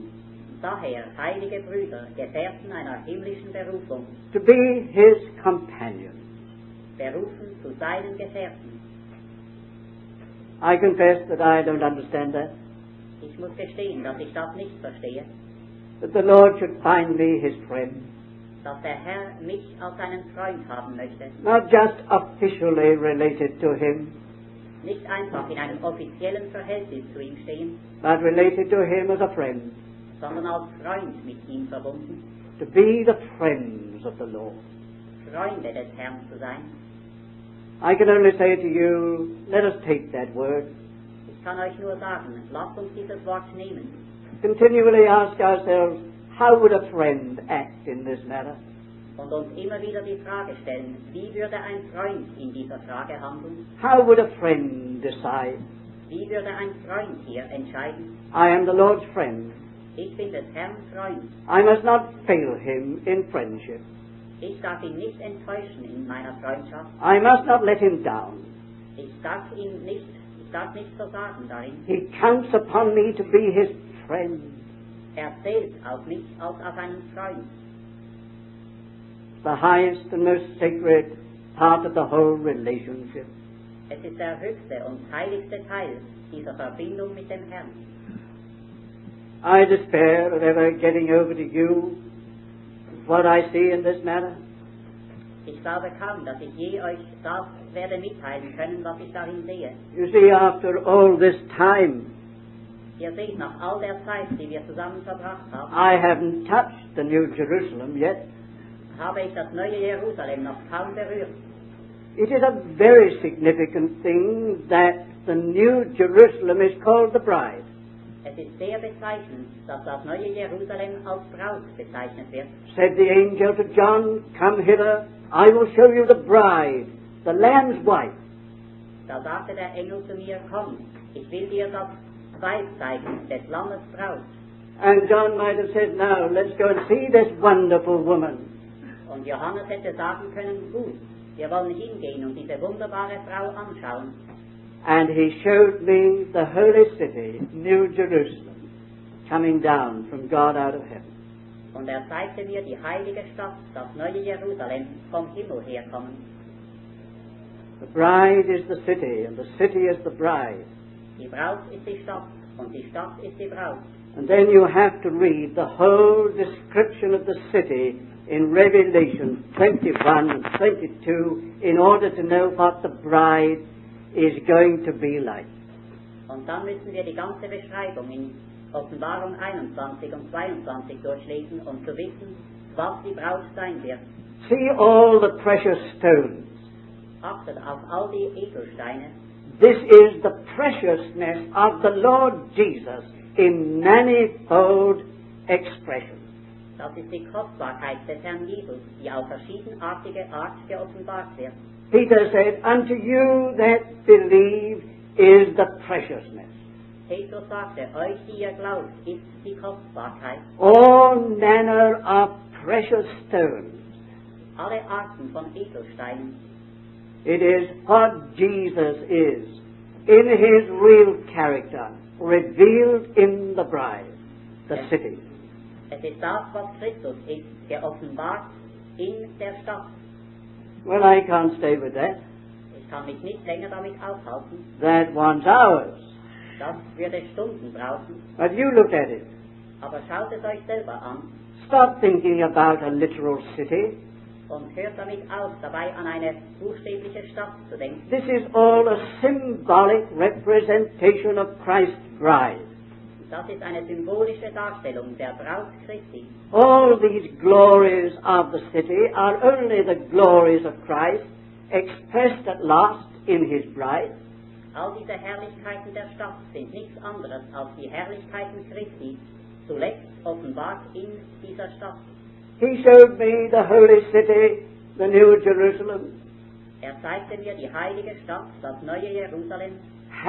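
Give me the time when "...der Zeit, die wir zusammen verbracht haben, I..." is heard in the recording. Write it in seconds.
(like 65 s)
103 s.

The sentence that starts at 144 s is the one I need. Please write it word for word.
And he showed me the holy city, New Jerusalem, coming down from God out of heaven.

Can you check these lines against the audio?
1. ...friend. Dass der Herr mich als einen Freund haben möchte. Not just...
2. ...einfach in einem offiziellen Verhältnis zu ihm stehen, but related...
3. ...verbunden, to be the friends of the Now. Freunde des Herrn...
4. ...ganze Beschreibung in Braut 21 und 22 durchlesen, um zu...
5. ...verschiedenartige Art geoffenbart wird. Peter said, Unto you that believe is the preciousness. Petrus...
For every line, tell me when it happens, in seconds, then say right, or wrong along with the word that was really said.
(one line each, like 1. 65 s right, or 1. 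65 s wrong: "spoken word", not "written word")
1. 17 s right
2. 25 s right
3. 31 s wrong: "Lord", not "Now"
4. 177 s wrong: "Offenbarung", not "Braut"
5. 199 s right.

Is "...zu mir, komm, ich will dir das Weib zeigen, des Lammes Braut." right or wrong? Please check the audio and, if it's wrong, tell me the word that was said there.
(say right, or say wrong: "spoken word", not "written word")
right.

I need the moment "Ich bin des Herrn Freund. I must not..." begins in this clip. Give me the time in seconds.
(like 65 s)
59 s.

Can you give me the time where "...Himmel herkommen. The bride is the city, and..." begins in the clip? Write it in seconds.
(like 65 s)
155 s.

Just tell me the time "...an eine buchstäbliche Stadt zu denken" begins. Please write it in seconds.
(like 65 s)
245 s.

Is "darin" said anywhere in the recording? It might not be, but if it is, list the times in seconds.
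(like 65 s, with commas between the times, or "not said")
71 s, 99 s.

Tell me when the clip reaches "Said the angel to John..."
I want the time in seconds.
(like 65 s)
122 s.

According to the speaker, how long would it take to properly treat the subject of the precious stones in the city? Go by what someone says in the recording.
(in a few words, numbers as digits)
Hours.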